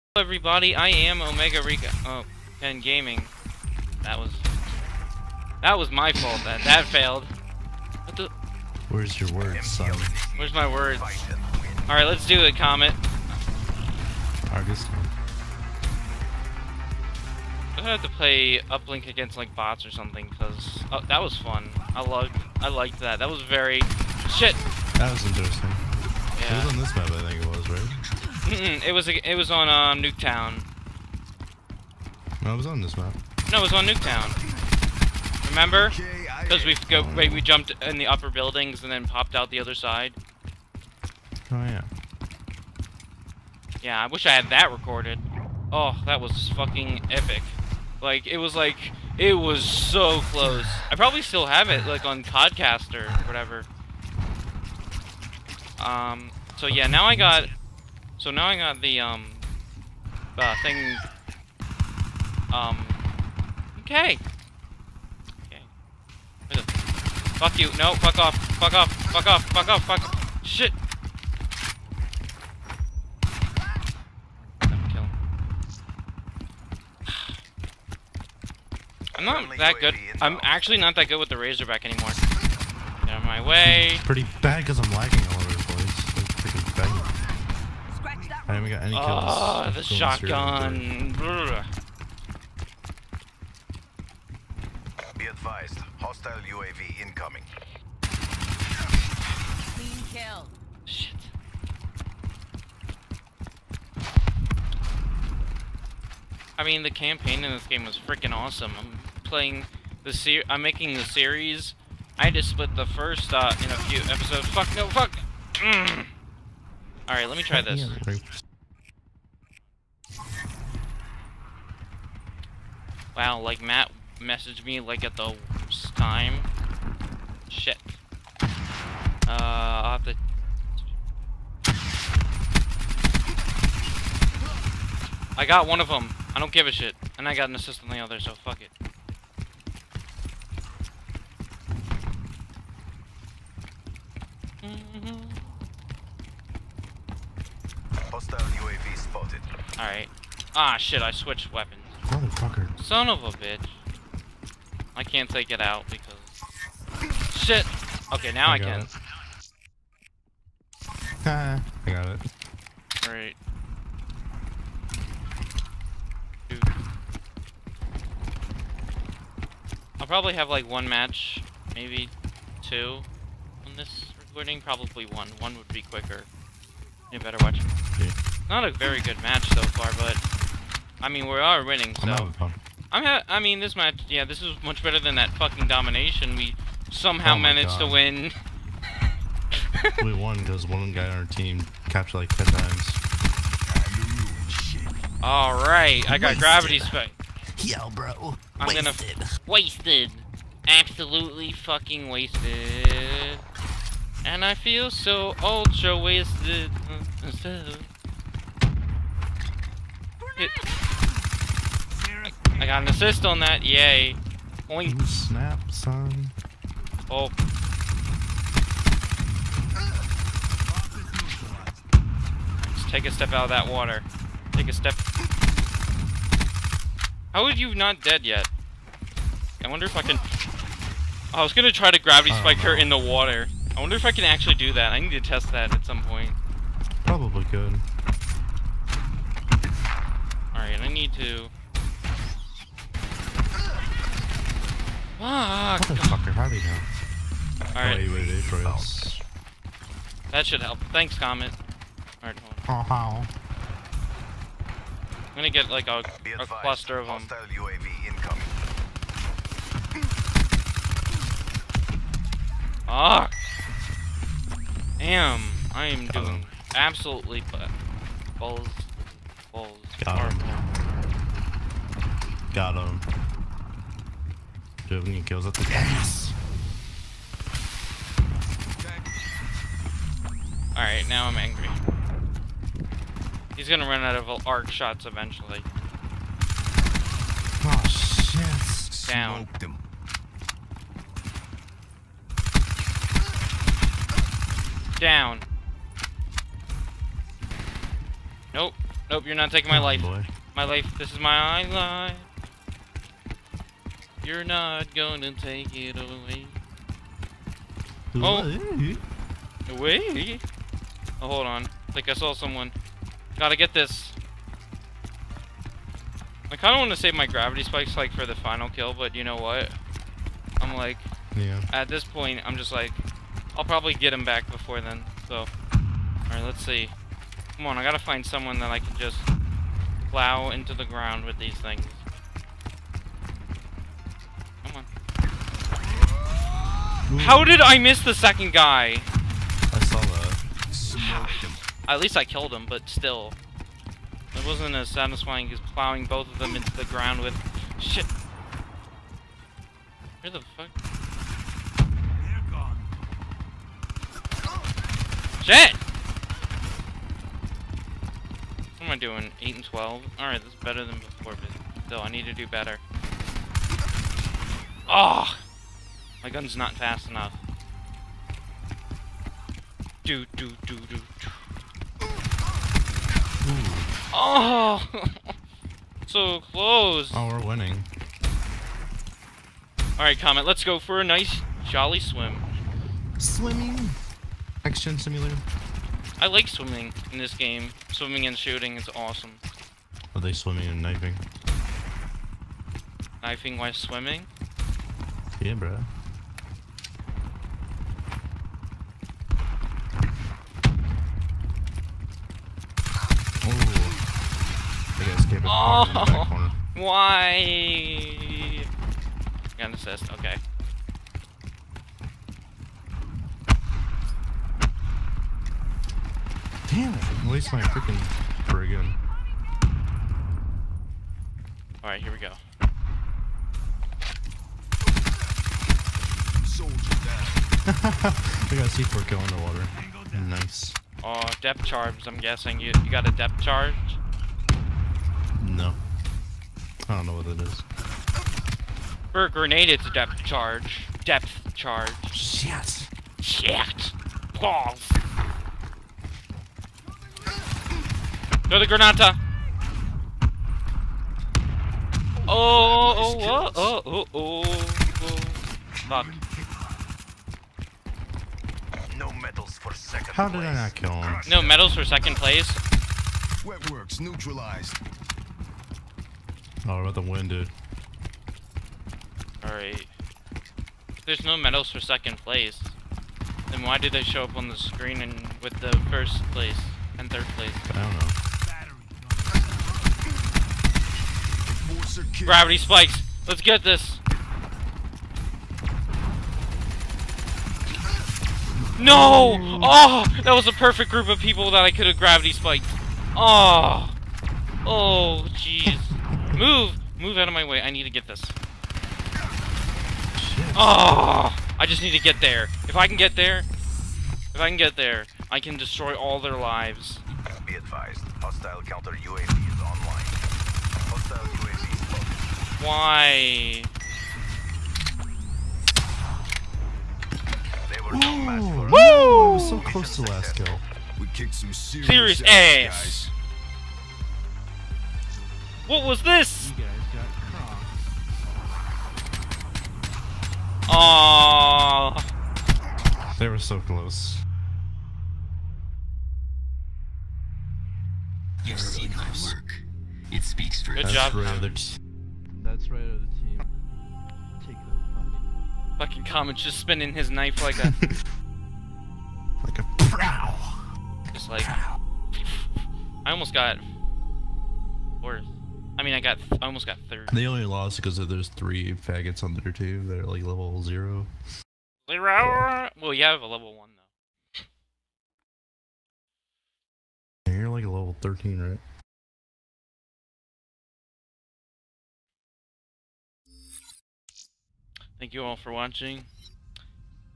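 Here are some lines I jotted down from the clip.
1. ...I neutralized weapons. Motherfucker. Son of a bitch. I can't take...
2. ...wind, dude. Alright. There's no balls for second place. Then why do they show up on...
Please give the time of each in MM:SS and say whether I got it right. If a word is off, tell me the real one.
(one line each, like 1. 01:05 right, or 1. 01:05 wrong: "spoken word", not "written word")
1. 02:31 wrong: "switched", not "neutralized"
2. 07:47 wrong: "medals", not "balls".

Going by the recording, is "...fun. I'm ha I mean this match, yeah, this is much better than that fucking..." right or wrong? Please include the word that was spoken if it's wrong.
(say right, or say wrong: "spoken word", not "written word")
right.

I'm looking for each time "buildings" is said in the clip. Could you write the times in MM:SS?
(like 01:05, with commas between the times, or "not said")
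00:38.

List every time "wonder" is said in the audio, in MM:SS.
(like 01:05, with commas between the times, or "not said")
03:49, 03:53.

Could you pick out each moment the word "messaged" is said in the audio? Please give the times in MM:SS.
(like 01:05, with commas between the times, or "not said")
02:04.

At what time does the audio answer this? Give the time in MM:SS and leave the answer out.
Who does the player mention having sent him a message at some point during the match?
02:03.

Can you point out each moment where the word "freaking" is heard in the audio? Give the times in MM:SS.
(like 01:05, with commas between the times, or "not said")
01:47, 06:57.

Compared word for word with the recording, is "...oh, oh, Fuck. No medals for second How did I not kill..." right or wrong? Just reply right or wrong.
right.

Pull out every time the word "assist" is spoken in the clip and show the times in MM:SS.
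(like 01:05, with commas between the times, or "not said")
02:17, 03:32, 06:49.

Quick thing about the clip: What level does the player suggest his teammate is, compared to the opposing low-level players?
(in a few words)
13.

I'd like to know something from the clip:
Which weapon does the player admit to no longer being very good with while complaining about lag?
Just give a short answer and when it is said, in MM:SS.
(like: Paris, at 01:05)
Razorback, at 01:21.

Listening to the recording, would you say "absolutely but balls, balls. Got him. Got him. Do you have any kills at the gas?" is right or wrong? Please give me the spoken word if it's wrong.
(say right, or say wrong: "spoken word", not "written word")
right.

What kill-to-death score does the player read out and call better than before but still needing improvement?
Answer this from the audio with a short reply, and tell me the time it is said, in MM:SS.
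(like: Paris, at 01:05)
8 and 12, at 05:59.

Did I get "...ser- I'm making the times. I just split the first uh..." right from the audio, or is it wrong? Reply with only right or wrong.
wrong.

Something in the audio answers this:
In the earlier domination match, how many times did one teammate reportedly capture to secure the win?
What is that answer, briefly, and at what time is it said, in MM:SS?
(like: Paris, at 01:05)
10, at 03:12.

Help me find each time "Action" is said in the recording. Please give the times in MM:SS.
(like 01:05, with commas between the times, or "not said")
06:24.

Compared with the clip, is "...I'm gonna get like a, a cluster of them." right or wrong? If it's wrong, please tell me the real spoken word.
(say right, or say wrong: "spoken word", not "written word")
right.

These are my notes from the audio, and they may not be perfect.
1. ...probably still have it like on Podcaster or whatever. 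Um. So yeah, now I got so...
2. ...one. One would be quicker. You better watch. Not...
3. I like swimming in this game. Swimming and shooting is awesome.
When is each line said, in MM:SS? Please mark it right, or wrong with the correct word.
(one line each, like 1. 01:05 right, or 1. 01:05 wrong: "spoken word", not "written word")
1. 00:50 right
2. 02:55 right
3. 06:26 right.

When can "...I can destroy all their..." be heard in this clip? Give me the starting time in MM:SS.
08:25.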